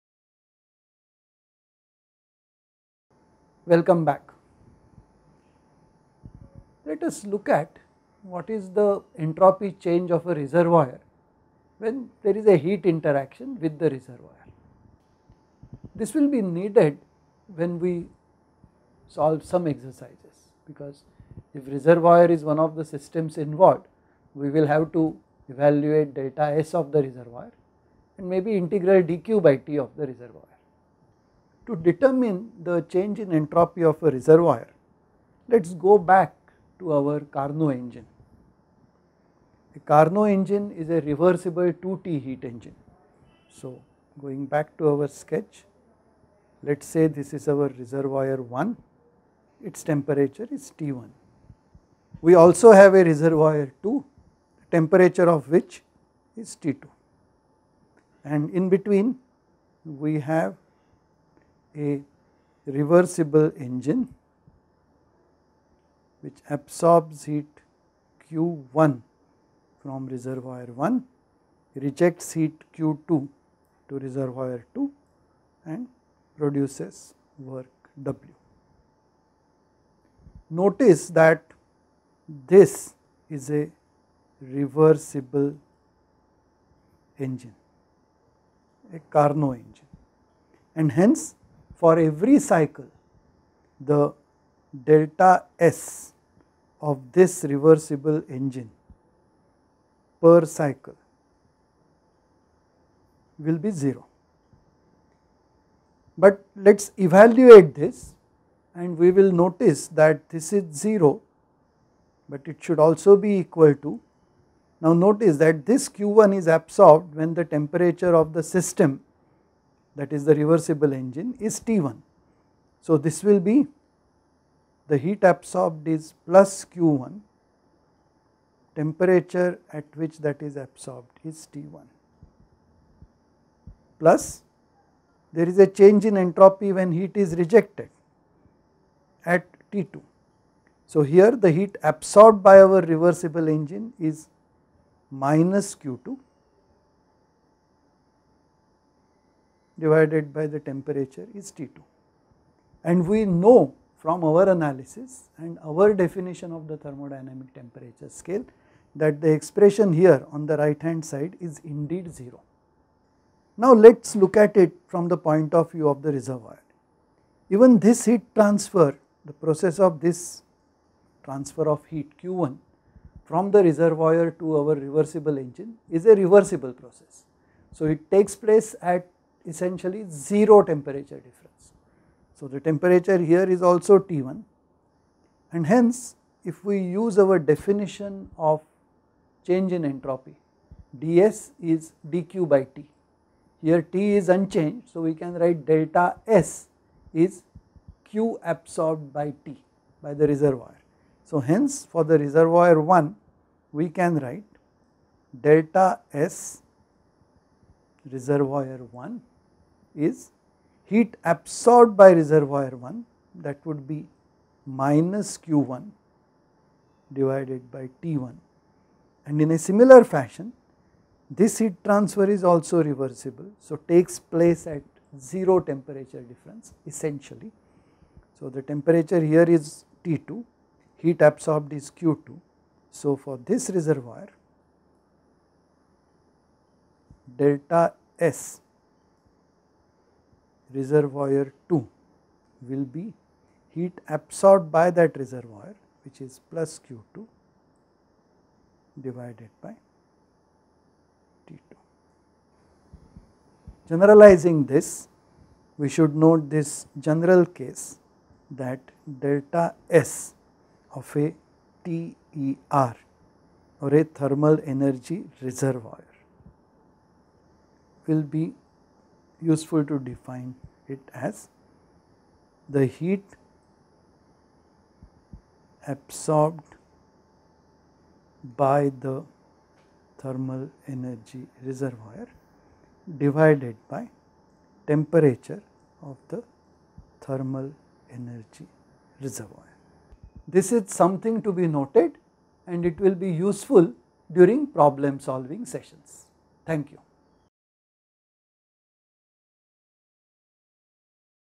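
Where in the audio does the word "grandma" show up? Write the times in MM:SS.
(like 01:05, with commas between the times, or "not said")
not said.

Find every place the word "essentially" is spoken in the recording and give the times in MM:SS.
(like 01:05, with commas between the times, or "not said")
02:59, 03:46.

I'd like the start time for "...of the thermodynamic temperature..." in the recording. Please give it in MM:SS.
02:36.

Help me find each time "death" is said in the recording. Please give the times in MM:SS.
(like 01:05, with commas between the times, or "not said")
not said.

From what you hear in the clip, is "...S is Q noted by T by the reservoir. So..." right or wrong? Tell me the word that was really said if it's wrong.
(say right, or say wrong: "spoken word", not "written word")
wrong: "absorbed", not "noted".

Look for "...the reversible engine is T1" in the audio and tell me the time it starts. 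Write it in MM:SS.
02:00.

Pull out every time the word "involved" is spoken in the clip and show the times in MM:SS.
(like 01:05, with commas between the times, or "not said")
00:23.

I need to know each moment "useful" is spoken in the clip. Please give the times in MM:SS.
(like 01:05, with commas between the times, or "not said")
04:29, 04:53.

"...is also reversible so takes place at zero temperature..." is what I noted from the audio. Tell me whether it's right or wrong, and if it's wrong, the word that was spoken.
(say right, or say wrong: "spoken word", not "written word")
right.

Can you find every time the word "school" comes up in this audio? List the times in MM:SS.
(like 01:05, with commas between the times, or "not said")
not said.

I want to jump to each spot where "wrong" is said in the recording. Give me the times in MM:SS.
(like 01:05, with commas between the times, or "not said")
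not said.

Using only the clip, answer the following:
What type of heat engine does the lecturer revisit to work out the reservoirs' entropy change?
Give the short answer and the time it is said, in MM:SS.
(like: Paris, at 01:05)
reversible 2T heat engine, at 00:41.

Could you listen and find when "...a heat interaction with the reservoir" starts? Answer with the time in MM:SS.
00:12.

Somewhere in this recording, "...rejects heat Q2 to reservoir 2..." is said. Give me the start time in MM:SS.
01:11.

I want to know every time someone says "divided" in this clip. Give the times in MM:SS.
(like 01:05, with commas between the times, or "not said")
02:29, 03:37, 04:09, 04:43.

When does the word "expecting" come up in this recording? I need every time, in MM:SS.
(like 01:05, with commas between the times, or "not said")
not said.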